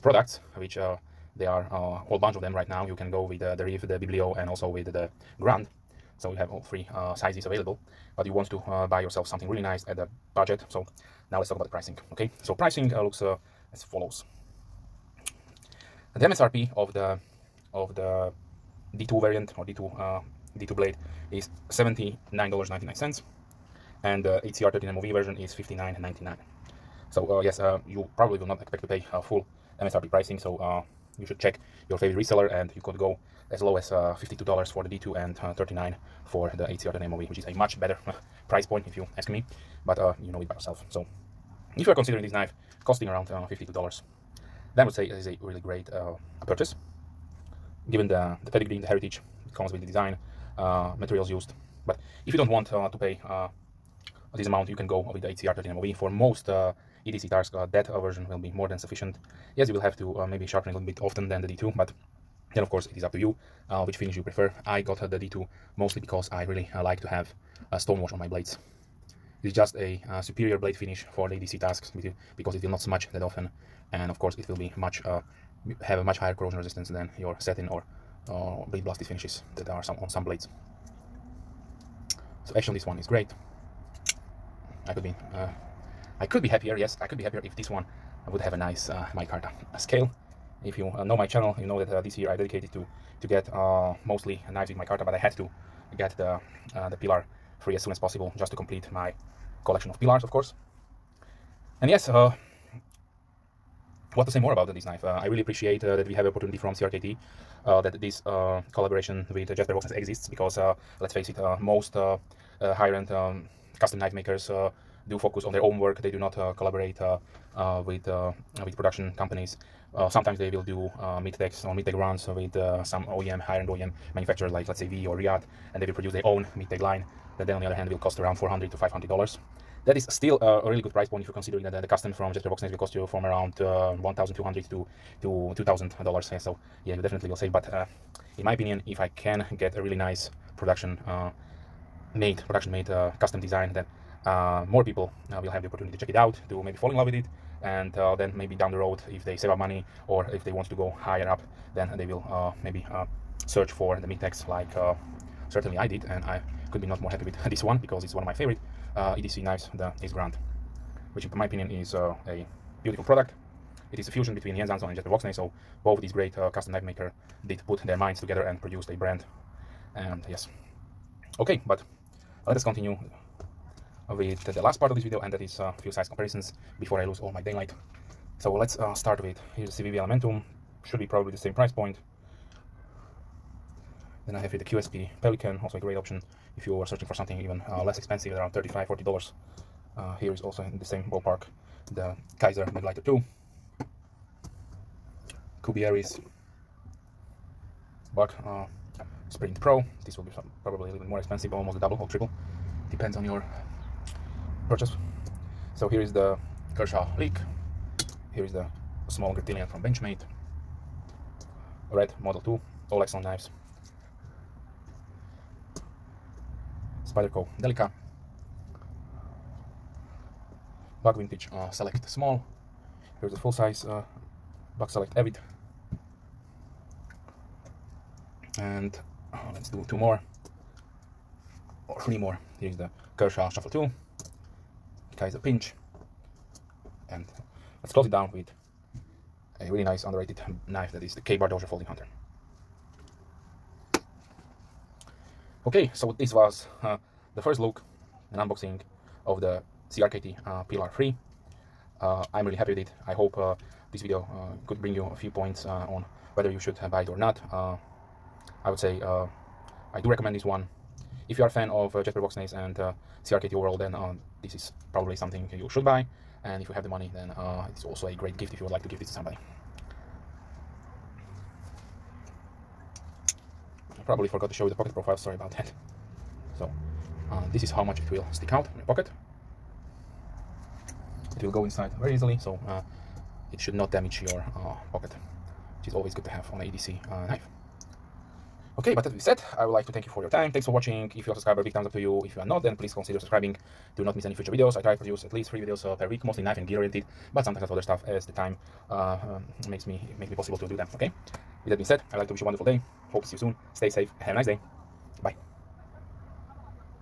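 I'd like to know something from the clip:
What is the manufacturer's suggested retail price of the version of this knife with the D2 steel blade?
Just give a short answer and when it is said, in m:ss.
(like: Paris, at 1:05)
$79.99, at 0:21.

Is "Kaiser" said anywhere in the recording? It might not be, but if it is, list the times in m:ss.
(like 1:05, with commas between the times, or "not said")
3:55.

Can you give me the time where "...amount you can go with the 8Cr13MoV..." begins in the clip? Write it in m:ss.
0:54.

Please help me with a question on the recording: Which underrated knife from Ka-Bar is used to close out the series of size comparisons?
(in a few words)
Dozer Folding Hunter.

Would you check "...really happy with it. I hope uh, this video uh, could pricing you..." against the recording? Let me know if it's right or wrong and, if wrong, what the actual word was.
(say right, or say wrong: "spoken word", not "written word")
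wrong: "bring", not "pricing".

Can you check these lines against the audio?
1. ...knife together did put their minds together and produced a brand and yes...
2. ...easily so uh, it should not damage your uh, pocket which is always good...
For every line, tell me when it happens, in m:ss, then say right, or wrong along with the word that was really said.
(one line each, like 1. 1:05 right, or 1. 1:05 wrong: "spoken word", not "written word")
1. 2:46 wrong: "maker", not "together"
2. 4:42 right.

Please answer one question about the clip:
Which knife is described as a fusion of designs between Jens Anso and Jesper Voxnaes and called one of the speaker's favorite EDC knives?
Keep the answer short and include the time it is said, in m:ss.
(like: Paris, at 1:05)
Ace Grand, at 2:39.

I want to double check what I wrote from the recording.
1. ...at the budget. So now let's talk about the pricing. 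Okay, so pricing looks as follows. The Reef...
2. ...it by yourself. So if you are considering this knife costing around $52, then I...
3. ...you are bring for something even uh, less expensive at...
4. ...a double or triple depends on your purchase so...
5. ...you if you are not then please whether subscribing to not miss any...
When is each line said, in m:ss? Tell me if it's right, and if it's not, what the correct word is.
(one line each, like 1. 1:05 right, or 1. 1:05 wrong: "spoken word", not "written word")
1. 0:09 wrong: "MSRP", not "Reef"
2. 0:40 right
3. 3:06 wrong: "searching", not "bring"
4. 3:21 right
5. 4:51 wrong: "consider", not "whether".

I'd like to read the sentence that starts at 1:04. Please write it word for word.
I got uh, the D2 mostly because I really uh, like to have a stone wash on my blades.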